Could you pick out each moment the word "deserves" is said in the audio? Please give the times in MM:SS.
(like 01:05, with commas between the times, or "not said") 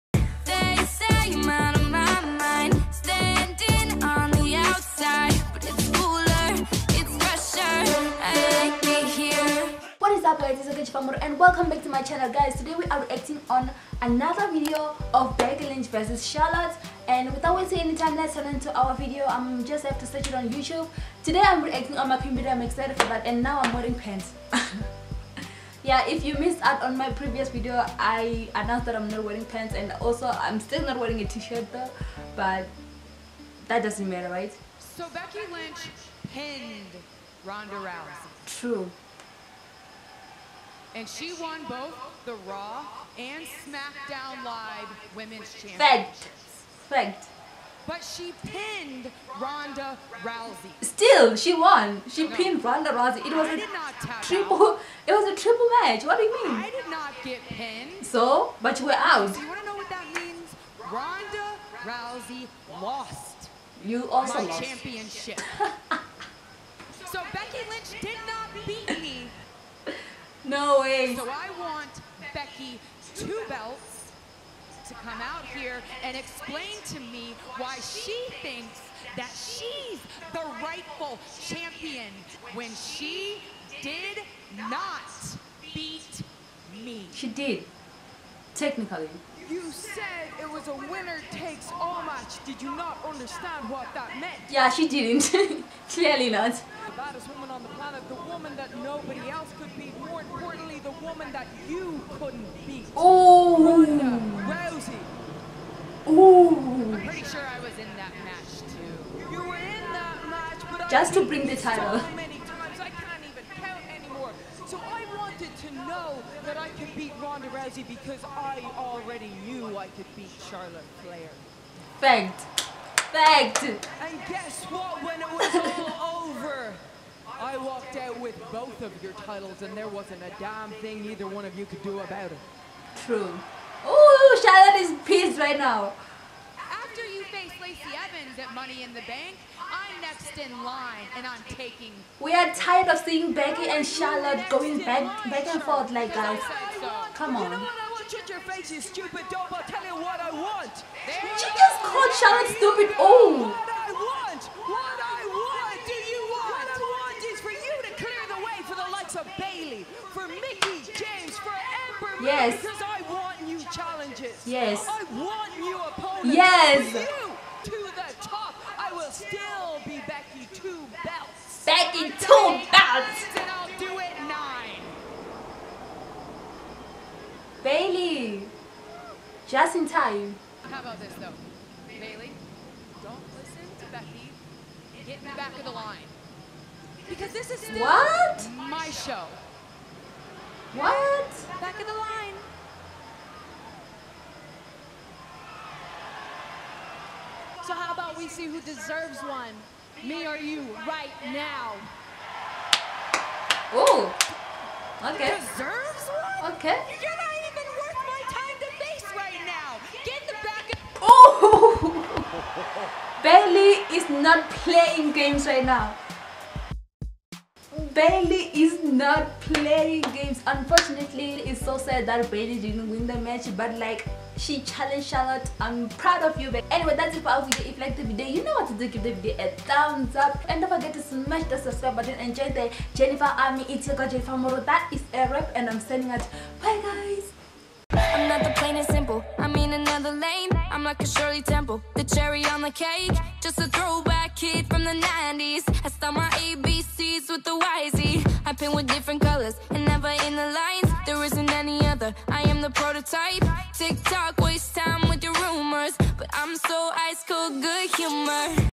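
03:18, 03:25.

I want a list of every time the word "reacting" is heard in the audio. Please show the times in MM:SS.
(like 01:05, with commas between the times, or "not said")
00:13, 00:21.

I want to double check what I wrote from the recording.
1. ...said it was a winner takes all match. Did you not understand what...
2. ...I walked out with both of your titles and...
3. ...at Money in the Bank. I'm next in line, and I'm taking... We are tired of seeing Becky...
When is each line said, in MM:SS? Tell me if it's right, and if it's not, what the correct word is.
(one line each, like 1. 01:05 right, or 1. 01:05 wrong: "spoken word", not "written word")
1. 01:29 right
2. 02:07 right
3. 02:18 right.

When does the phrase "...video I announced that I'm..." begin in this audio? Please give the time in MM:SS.
00:27.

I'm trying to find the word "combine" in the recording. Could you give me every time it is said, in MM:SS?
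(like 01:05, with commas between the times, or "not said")
not said.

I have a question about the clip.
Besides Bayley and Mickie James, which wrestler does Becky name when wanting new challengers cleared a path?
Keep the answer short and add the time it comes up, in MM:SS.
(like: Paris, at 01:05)
Ember, at 02:41.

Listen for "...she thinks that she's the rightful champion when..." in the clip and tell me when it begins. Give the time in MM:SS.
01:17.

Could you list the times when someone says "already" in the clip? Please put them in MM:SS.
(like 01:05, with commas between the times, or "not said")
01:58.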